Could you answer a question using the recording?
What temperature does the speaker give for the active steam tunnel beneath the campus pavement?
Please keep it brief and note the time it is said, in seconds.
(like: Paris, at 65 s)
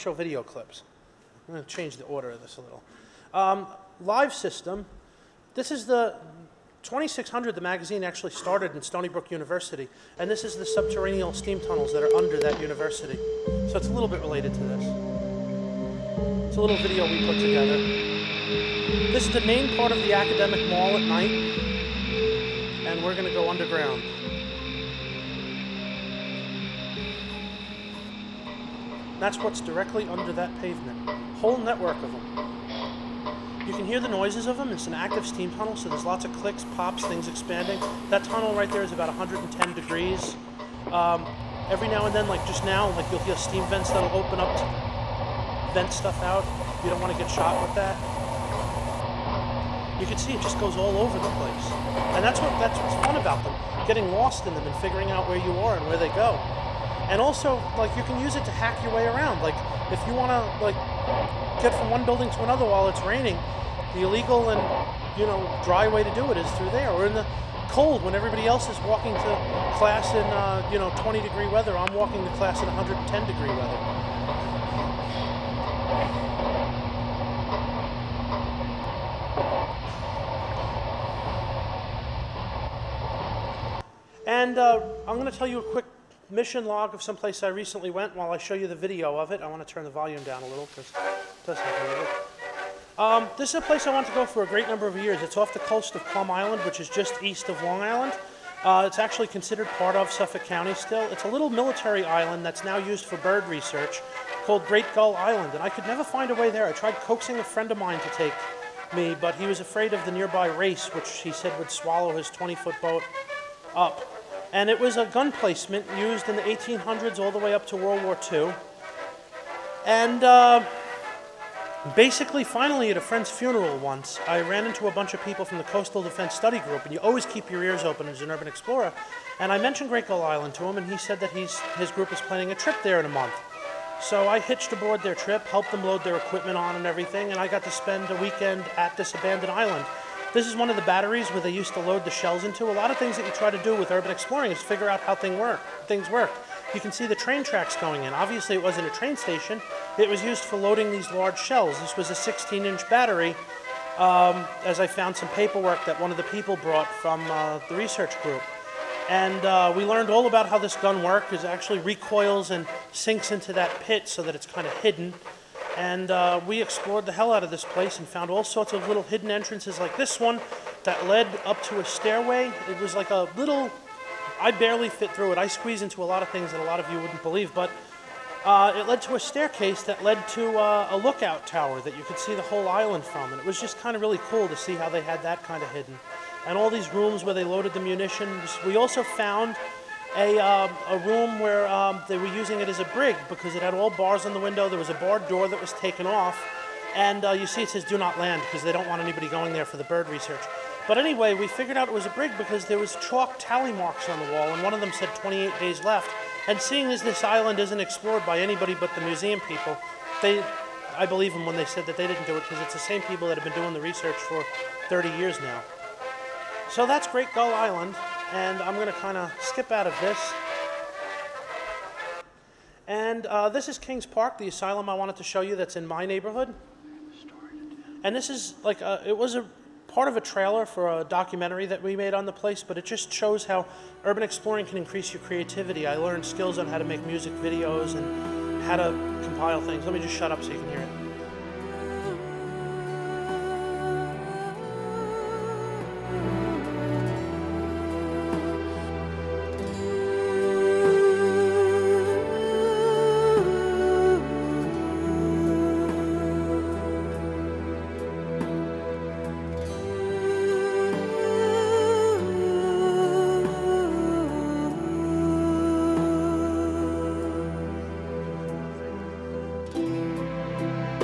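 110 degrees, at 39 s.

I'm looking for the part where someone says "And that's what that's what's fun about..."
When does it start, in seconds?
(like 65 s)
52 s.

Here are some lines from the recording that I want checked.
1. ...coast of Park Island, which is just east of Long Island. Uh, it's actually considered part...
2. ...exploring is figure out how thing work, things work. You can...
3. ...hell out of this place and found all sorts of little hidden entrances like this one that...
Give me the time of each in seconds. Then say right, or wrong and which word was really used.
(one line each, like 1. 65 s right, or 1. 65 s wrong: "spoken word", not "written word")
1. 95 s wrong: "Plum", not "Park"
2. 144 s right
3. 167 s right.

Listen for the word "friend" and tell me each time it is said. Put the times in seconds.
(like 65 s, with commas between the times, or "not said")
107 s, 122 s.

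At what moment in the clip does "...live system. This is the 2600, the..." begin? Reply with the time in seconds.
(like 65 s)
3 s.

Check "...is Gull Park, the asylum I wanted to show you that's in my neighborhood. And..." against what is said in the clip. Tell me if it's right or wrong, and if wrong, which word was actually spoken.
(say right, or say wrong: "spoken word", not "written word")
wrong: "Kings", not "Gull".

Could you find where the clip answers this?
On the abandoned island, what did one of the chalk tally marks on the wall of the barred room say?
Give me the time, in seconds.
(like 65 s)
205 s.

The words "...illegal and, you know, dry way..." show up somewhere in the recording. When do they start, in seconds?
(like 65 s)
64 s.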